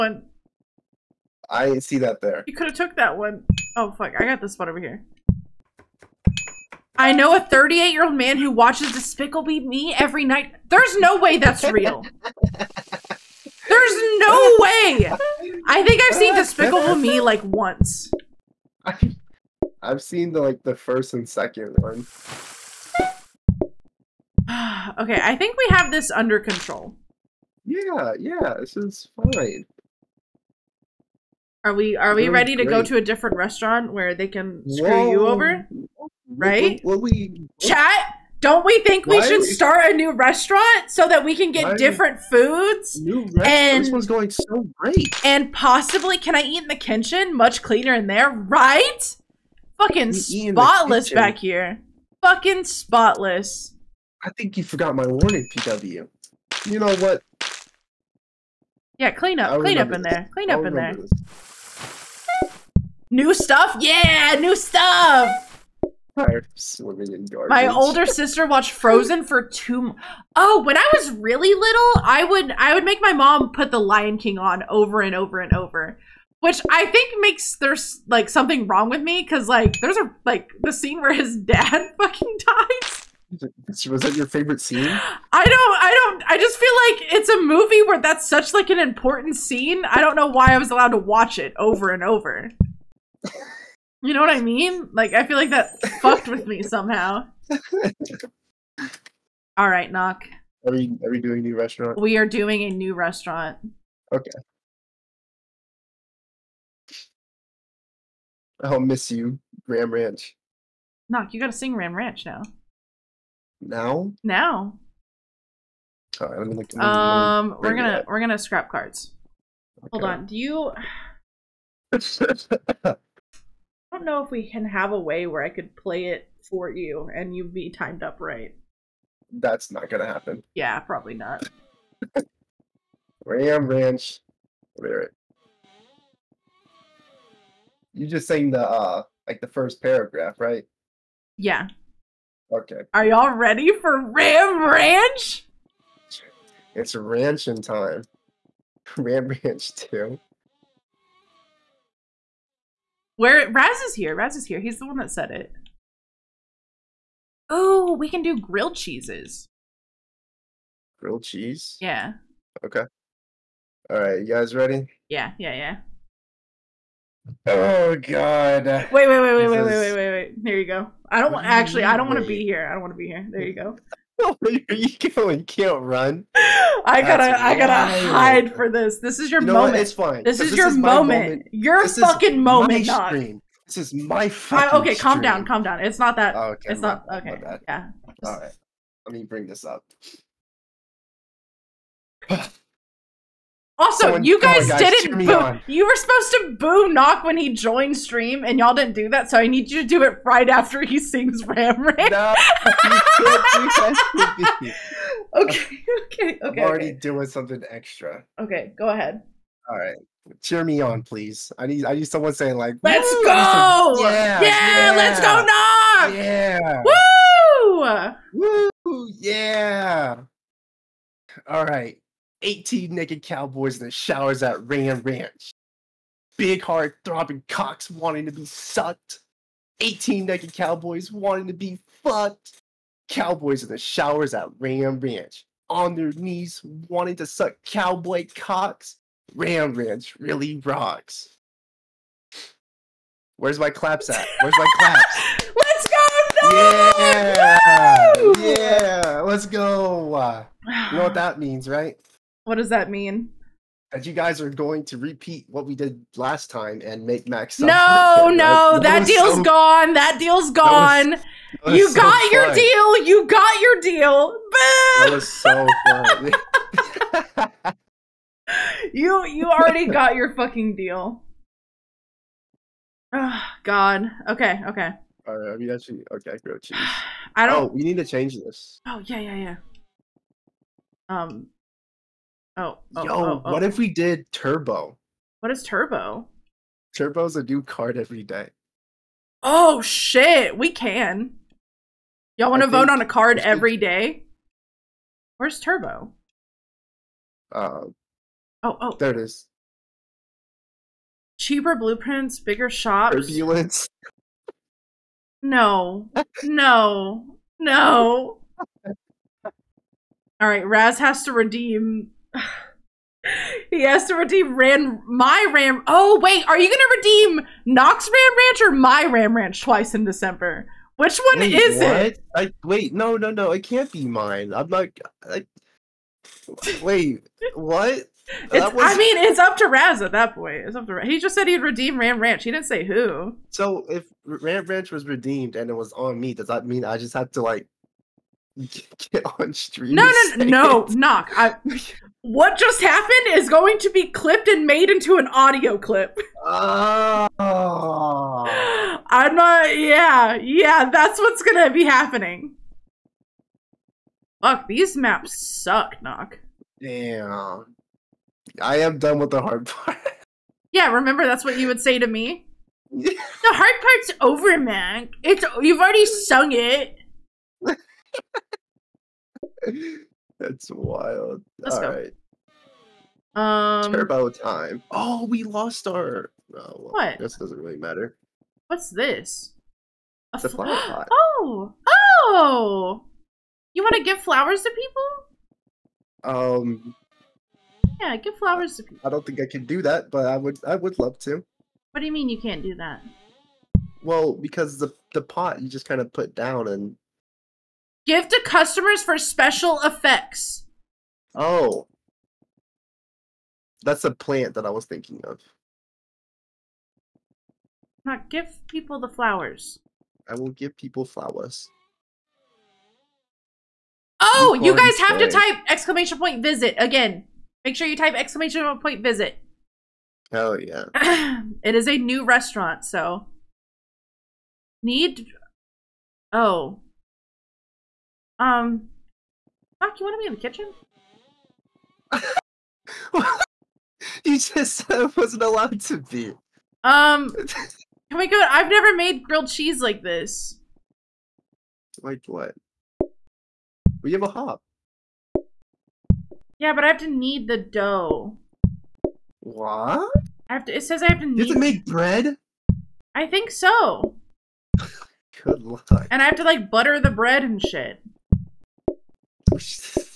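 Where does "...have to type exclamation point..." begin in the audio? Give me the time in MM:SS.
06:55.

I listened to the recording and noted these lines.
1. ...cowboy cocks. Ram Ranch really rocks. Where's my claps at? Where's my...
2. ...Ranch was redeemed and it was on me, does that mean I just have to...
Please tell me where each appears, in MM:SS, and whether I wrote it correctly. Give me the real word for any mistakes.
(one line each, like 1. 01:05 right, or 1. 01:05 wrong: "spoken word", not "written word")
1. 03:57 right
2. 05:34 right.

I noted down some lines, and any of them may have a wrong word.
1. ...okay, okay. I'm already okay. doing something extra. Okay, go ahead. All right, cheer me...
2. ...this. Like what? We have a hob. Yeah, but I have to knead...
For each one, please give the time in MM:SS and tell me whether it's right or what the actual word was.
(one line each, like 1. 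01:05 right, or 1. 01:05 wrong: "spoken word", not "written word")
1. 03:25 right
2. 07:20 right.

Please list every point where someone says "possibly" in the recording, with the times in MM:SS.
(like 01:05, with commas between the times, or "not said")
00:45.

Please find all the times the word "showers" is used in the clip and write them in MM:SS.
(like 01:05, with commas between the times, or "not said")
03:43, 03:53.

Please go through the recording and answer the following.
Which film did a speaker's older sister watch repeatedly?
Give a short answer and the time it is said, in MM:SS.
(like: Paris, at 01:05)
Frozen, at 01:08.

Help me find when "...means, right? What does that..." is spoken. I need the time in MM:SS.
04:11.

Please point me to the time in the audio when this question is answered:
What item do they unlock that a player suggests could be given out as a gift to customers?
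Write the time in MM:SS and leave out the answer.
06:20.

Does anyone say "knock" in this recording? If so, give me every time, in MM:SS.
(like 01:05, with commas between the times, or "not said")
01:39, 01:51, 03:16, 03:35, 05:17, 05:40, 05:56.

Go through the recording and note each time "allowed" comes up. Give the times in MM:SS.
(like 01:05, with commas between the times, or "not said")
01:30, 07:15.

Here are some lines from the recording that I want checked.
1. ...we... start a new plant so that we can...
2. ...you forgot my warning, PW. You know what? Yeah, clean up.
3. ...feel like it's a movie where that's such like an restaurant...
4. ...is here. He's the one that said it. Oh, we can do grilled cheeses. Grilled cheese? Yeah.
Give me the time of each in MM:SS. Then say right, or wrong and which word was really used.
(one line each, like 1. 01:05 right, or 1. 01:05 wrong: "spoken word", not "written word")
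1. 00:39 wrong: "restaurant", not "plant"
2. 00:54 right
3. 01:26 wrong: "important", not "restaurant"
4. 02:34 right.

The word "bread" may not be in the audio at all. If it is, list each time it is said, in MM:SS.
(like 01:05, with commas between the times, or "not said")
07:31, 07:37.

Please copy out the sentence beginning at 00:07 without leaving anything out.
I know a 38 year old man who watches Despicable Me every night.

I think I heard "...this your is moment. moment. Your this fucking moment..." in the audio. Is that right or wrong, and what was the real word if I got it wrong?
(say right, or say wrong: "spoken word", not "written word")
right.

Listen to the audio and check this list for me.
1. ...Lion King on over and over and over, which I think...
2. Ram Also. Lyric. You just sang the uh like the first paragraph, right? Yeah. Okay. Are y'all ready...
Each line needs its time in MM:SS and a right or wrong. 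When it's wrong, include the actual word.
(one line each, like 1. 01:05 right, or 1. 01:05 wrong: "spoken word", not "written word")
1. 01:13 right
2. 02:13 wrong: "Ranch", not "Also".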